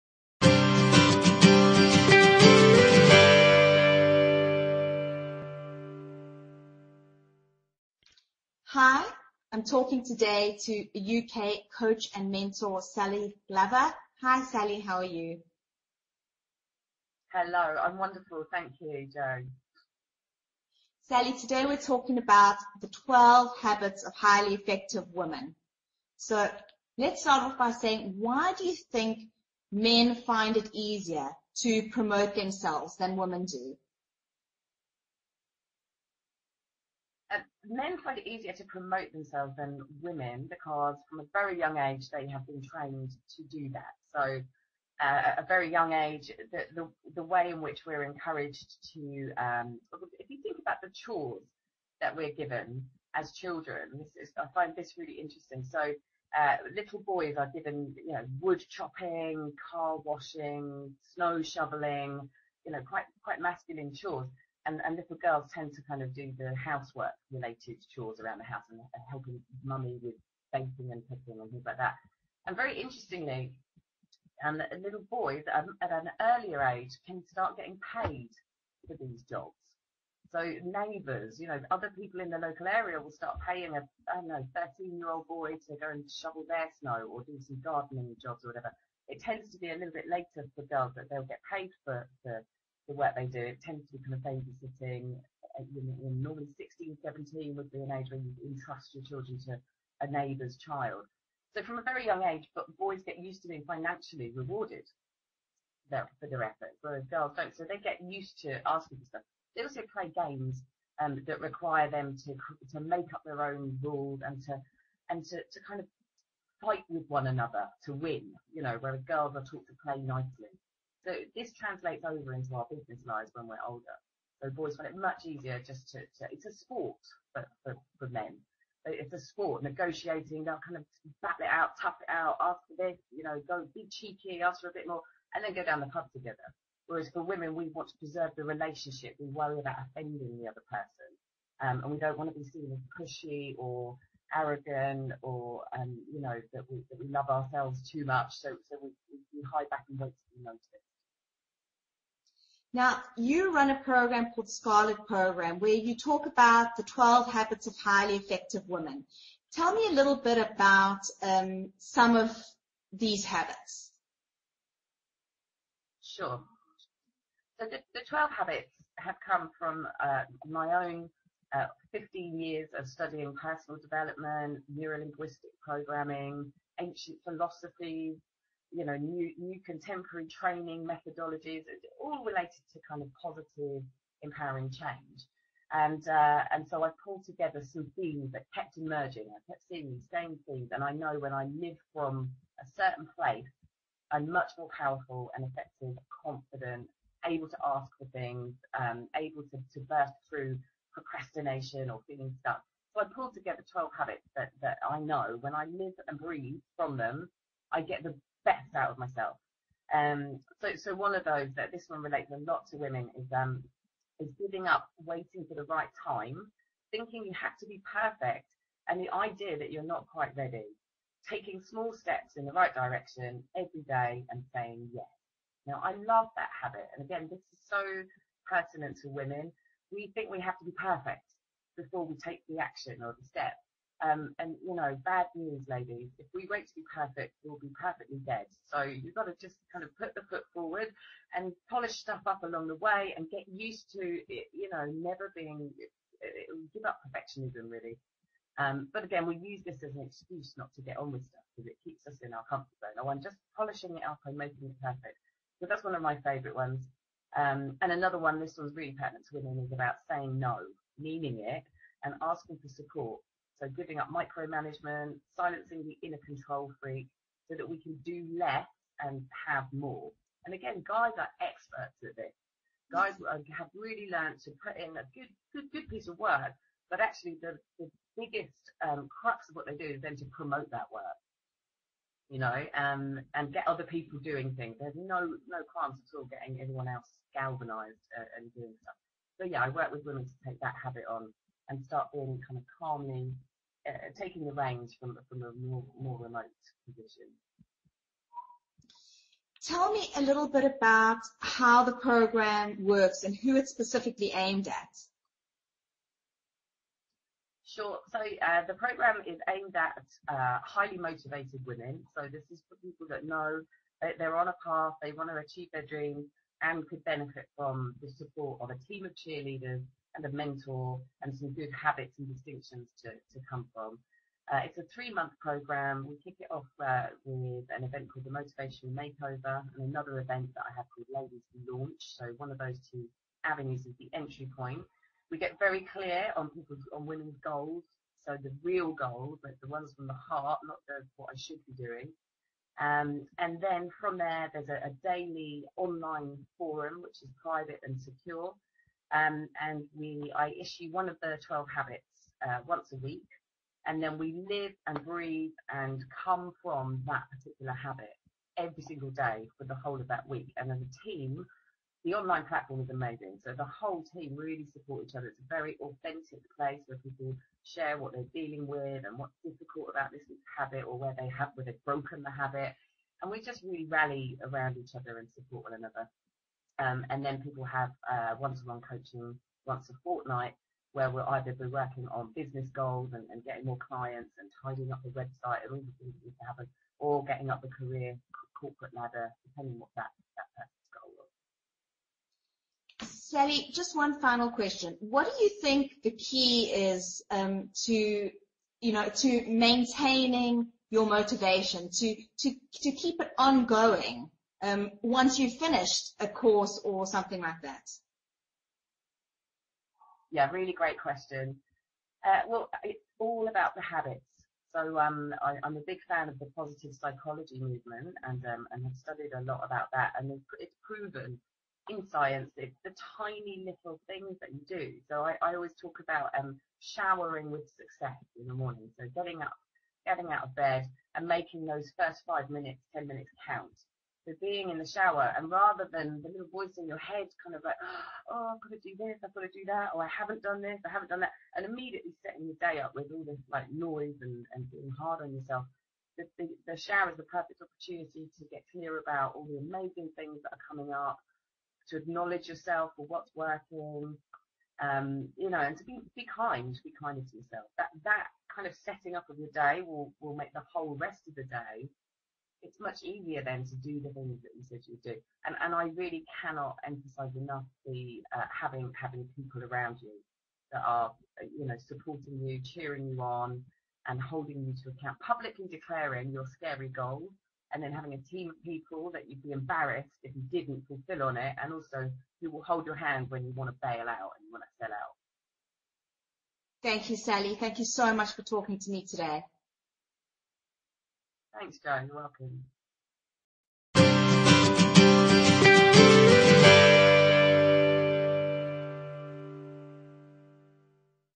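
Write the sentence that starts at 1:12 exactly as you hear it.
And very interestingly, um, little boys at, at an earlier age can start getting paid for these jobs.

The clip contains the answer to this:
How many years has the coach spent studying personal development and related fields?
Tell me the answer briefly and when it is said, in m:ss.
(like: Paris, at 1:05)
15, at 2:51.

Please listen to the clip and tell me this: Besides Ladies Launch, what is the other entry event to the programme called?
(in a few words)
Motivation Makeover.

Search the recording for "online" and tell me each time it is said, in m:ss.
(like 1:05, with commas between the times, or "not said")
5:45, 6:02.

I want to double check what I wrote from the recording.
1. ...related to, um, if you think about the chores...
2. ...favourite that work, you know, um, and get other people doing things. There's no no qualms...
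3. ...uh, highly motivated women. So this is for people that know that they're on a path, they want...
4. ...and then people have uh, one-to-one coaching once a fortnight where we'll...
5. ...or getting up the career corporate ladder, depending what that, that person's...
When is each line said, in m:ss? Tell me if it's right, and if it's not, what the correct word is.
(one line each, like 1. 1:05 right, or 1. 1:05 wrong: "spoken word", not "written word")
1. 0:48 wrong: "encouraged", not "related"
2. 4:40 wrong: "promote", not "favourite"
3. 5:10 right
4. 6:17 right
5. 6:26 right.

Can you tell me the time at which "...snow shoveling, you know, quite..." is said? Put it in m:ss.
1:01.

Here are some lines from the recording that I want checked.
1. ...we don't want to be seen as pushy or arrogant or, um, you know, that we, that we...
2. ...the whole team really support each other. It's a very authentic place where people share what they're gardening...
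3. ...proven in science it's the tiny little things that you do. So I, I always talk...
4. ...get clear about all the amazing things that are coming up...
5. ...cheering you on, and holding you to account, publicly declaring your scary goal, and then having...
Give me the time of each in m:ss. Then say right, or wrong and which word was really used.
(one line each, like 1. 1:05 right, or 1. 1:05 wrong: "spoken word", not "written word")
1. 2:21 right
2. 6:03 wrong: "dealing", not "gardening"
3. 7:00 right
4. 7:28 right
5. 7:52 right.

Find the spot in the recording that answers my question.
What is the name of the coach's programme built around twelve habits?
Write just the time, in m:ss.
2:34.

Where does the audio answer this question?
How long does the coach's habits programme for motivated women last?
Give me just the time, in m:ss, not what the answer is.
5:24.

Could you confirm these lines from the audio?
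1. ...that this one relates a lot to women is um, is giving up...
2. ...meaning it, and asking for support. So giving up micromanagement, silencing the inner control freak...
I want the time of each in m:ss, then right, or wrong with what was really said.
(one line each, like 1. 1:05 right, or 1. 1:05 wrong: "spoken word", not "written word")
1. 3:31 right
2. 4:20 right.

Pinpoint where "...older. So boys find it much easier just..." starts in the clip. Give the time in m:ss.
2:03.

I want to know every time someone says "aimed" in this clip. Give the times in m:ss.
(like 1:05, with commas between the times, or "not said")
5:04, 5:09.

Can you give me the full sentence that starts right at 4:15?
So that's one of my favourite ones.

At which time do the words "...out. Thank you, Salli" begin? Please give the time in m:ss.
8:04.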